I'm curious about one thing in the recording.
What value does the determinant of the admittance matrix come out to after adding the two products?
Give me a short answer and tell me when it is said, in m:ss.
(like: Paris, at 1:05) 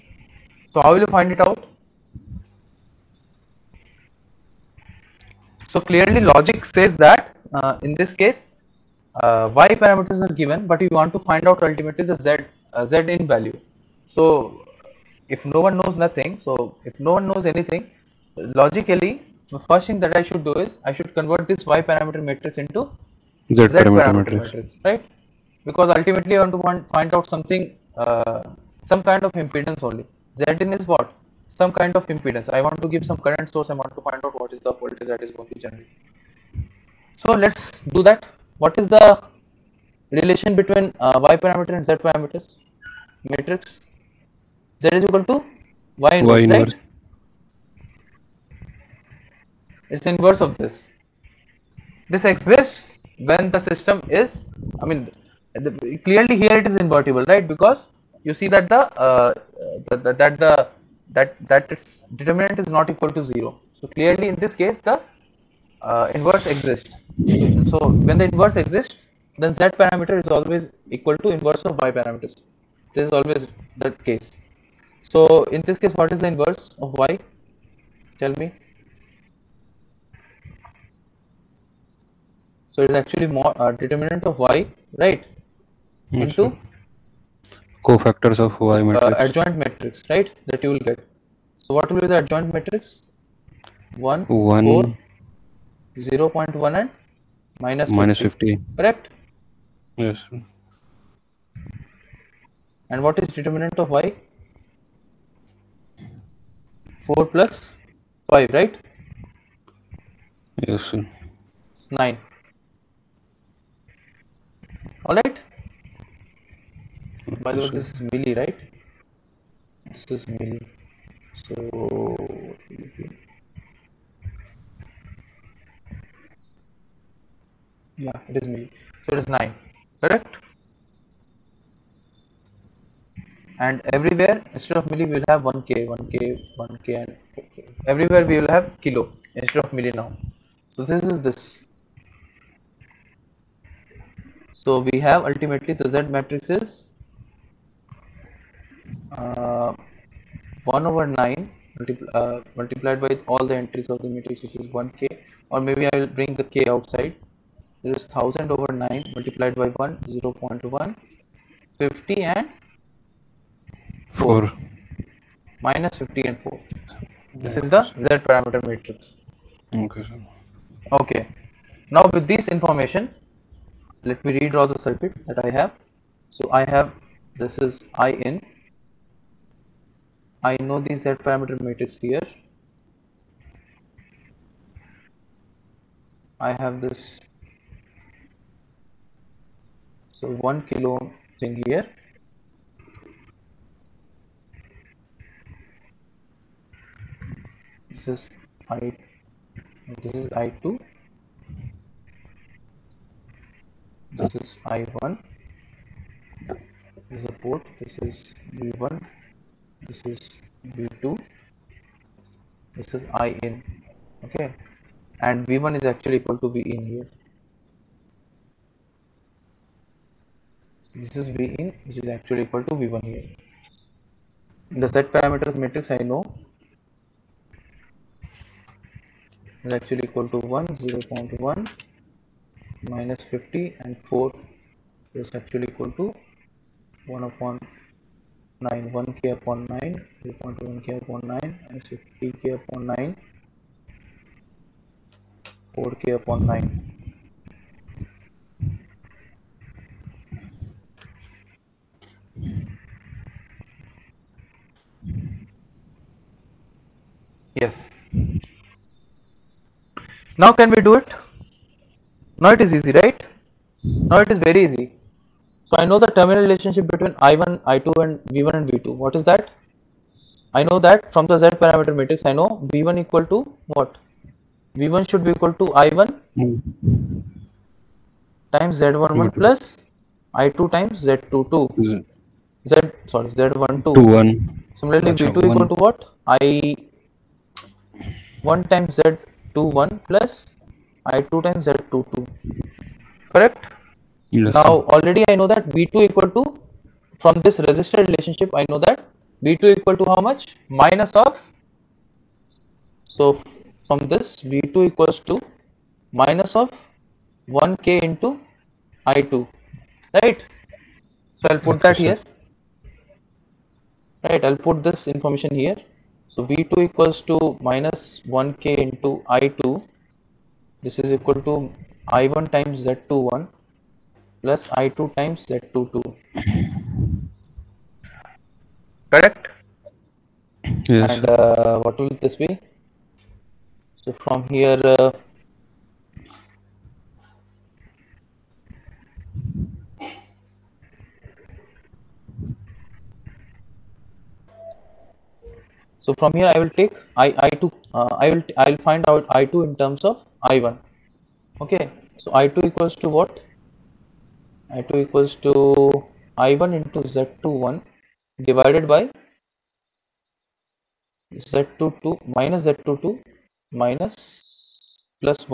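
9, at 1:51.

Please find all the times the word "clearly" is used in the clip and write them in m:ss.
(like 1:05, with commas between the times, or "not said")
0:05, 0:56, 1:03.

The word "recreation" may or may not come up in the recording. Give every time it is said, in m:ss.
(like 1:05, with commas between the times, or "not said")
not said.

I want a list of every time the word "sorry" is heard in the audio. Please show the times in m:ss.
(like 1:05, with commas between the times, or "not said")
4:43, 4:51.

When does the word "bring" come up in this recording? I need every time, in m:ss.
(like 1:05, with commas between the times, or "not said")
2:36.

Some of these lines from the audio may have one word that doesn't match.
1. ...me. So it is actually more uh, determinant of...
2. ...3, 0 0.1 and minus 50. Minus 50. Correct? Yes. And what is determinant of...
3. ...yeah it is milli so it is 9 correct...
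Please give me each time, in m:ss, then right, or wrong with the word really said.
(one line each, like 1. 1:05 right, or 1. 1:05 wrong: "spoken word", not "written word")
1. 1:18 right
2. 1:34 wrong: "4", not "3"
3. 2:08 right.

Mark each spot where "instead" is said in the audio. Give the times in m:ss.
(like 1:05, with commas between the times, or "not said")
2:14, 2:19.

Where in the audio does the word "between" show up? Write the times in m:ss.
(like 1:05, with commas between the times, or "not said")
0:40, 4:26.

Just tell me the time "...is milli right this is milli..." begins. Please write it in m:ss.
1:57.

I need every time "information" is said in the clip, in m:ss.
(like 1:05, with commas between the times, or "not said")
2:52, 5:15.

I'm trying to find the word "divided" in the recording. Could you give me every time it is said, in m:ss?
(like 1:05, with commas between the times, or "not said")
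5:58.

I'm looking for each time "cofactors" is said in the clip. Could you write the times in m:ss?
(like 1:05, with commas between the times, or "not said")
1:27.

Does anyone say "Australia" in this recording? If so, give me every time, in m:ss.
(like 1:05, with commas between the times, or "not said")
not said.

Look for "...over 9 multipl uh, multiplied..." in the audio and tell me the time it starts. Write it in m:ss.
2:30.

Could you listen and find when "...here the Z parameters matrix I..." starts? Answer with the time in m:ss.
3:43.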